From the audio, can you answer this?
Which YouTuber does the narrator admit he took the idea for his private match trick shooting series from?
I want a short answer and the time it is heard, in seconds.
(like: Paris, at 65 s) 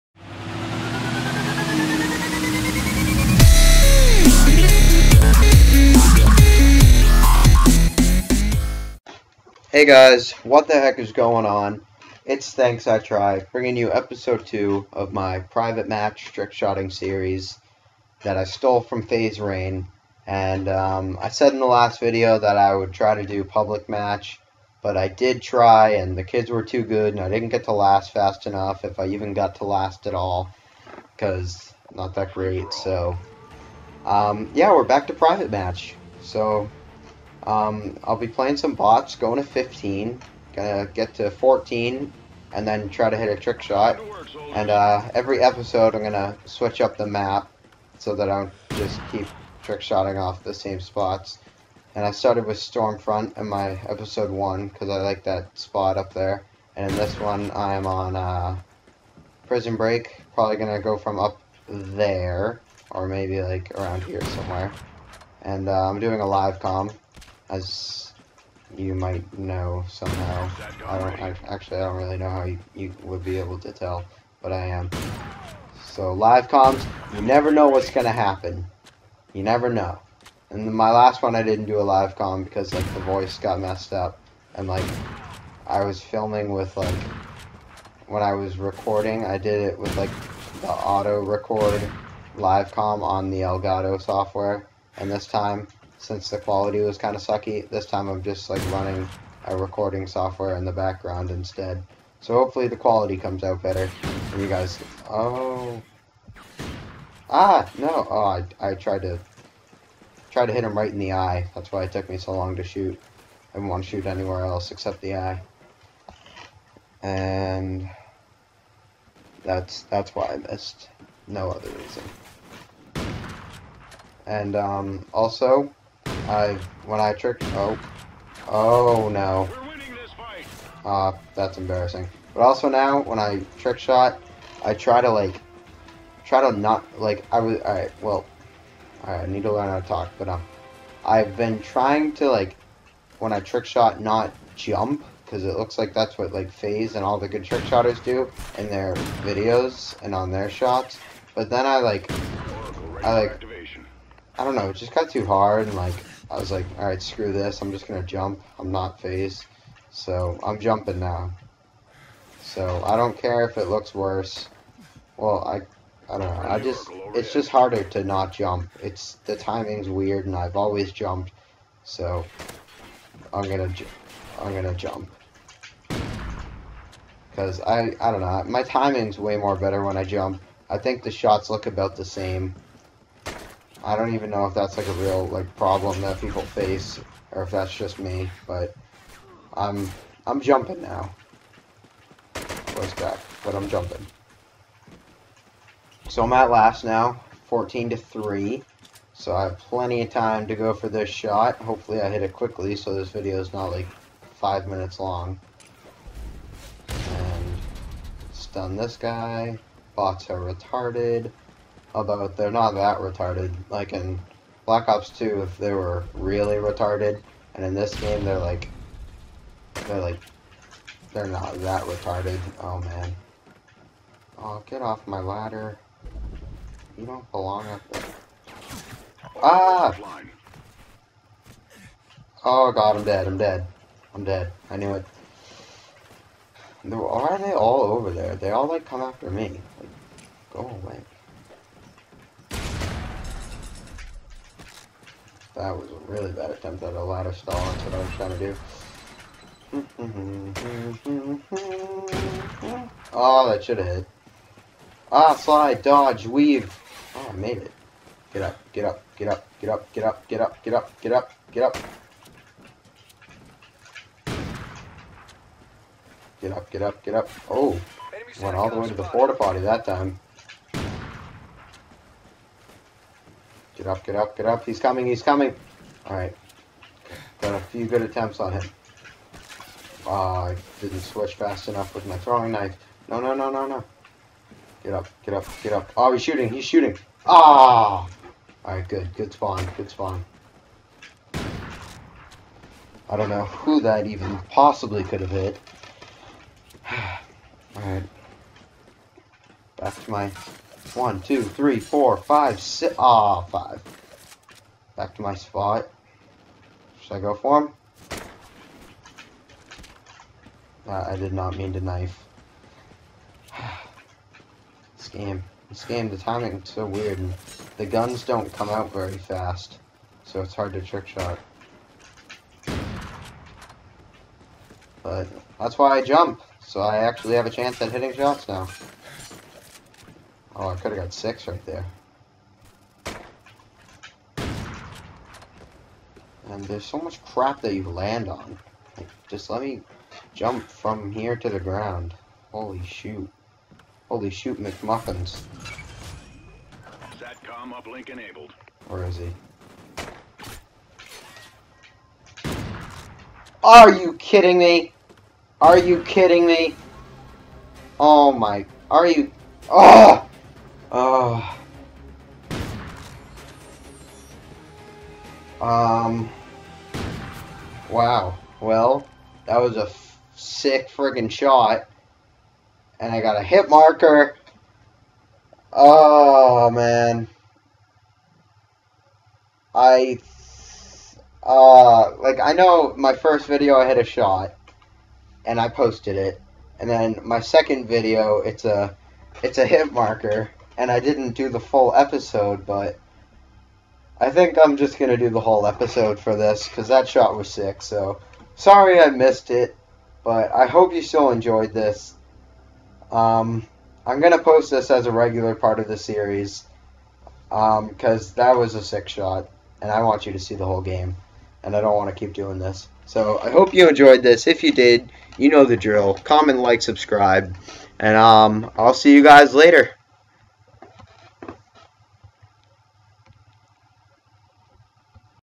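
FaZe Rain, at 19 s.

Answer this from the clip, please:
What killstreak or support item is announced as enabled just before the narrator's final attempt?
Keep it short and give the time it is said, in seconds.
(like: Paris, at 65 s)
Satcom uplink, at 347 s.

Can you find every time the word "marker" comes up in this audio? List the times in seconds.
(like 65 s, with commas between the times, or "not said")
373 s, 389 s.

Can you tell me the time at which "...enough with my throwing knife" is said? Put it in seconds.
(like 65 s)
281 s.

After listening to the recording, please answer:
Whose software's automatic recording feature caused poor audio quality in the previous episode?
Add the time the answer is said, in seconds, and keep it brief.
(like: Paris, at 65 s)
Elgato, at 93 s.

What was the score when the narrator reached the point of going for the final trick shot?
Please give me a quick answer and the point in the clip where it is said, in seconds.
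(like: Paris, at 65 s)
14 to 3, at 197 s.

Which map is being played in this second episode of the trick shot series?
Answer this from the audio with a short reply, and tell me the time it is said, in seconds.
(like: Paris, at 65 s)
Prison Break, at 59 s.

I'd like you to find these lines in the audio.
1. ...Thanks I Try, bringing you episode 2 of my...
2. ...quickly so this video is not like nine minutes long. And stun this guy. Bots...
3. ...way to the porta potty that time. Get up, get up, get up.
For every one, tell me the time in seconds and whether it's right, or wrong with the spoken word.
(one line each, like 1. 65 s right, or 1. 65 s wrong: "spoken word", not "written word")
1. 12 s right
2. 202 s wrong: "five", not "nine"
3. 268 s right.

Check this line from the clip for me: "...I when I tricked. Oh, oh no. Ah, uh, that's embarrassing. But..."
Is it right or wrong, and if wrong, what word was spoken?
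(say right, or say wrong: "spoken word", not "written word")
right.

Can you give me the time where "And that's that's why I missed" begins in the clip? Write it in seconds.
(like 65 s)
117 s.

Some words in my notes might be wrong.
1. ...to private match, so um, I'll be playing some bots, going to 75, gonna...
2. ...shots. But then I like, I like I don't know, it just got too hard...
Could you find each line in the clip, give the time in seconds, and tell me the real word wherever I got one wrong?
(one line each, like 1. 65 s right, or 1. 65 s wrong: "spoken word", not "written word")
1. 35 s wrong: "15", not "75"
2. 150 s right.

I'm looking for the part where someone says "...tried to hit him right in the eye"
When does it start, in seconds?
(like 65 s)
110 s.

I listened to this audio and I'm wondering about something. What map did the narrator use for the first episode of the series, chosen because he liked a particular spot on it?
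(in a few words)
Stormfront.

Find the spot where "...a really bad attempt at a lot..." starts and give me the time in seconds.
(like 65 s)
245 s.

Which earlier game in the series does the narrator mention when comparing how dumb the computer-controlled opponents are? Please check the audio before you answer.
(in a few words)
Black Ops 2.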